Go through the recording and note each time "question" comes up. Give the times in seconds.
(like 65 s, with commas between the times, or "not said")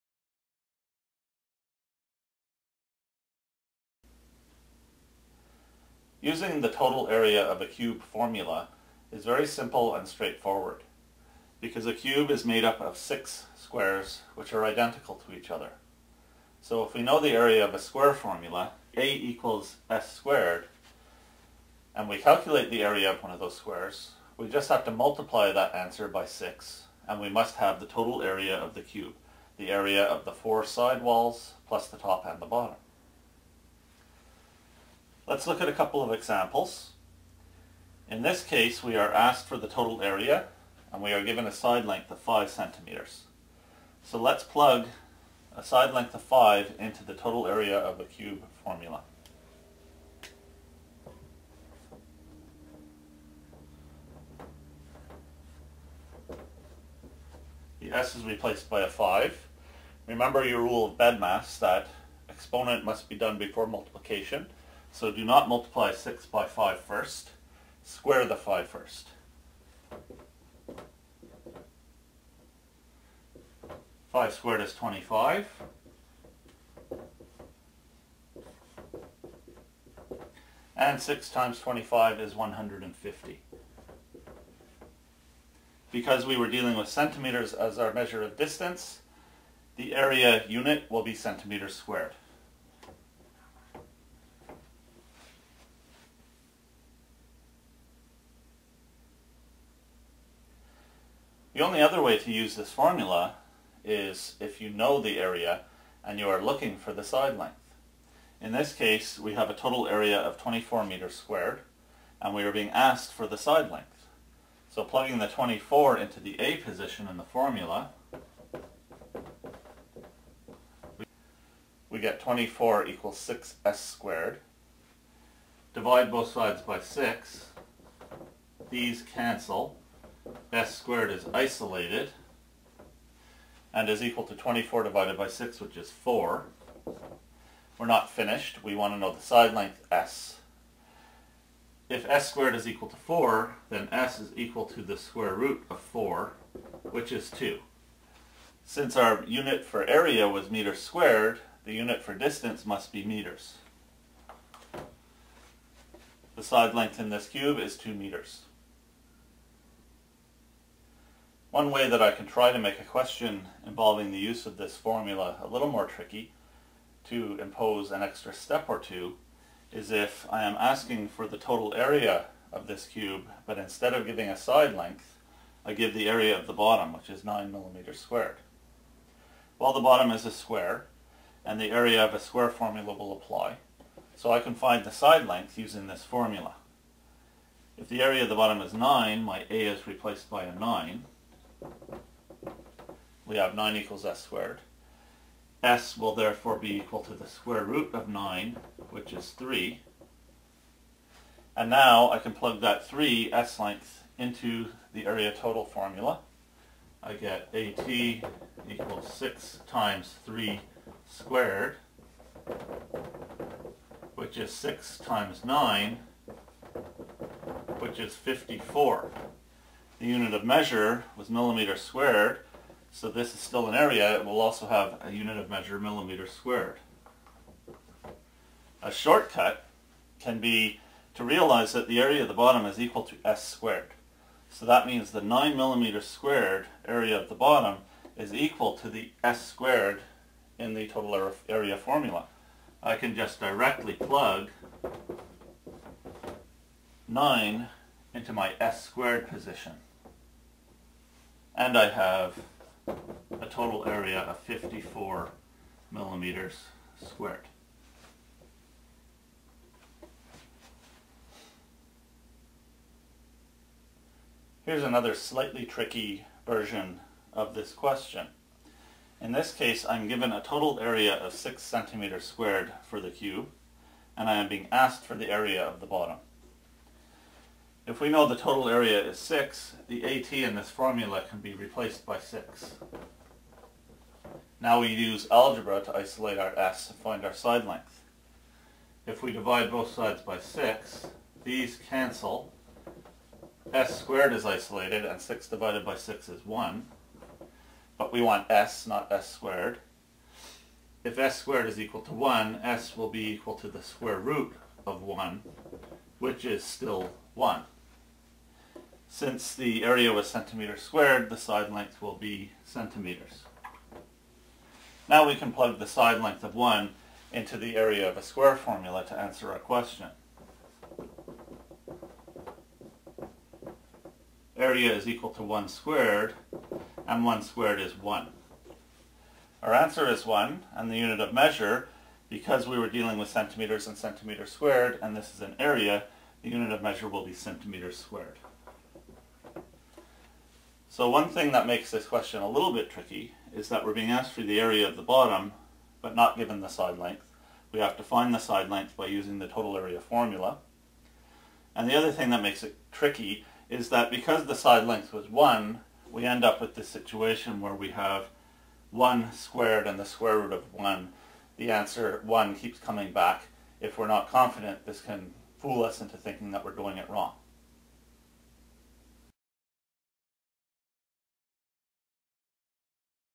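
162 s, 267 s, 319 s, 342 s.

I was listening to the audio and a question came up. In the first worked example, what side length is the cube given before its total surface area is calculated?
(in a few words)
5 centimeters.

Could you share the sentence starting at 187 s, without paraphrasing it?
If the area of the bottom is 9, my a is replaced by a 9, we have 9 equals s squared.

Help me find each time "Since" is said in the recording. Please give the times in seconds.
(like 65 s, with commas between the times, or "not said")
148 s, 309 s.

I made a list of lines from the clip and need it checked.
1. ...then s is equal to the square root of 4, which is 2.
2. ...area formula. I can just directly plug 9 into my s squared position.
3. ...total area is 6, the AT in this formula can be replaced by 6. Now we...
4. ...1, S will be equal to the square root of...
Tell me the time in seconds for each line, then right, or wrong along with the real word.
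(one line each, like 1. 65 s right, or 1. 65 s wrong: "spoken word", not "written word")
1. 143 s right
2. 241 s right
3. 278 s right
4. 302 s right.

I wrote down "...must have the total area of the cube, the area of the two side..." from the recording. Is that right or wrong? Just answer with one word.
wrong.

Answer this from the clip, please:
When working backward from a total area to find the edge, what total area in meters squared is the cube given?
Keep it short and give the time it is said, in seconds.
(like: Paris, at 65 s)
24 meters squared, at 110 s.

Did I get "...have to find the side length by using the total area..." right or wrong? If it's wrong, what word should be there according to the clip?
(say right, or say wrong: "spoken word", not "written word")
right.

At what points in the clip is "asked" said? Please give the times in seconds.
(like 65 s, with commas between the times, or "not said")
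39 s, 112 s, 274 s, 344 s.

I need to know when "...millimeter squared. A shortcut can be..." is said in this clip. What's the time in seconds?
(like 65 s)
225 s.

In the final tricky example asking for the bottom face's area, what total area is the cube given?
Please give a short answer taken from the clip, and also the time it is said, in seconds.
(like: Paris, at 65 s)
6 centimeters squared, at 271 s.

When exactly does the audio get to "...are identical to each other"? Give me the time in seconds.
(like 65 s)
14 s.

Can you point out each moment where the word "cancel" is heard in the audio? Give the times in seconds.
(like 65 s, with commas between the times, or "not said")
129 s, 291 s.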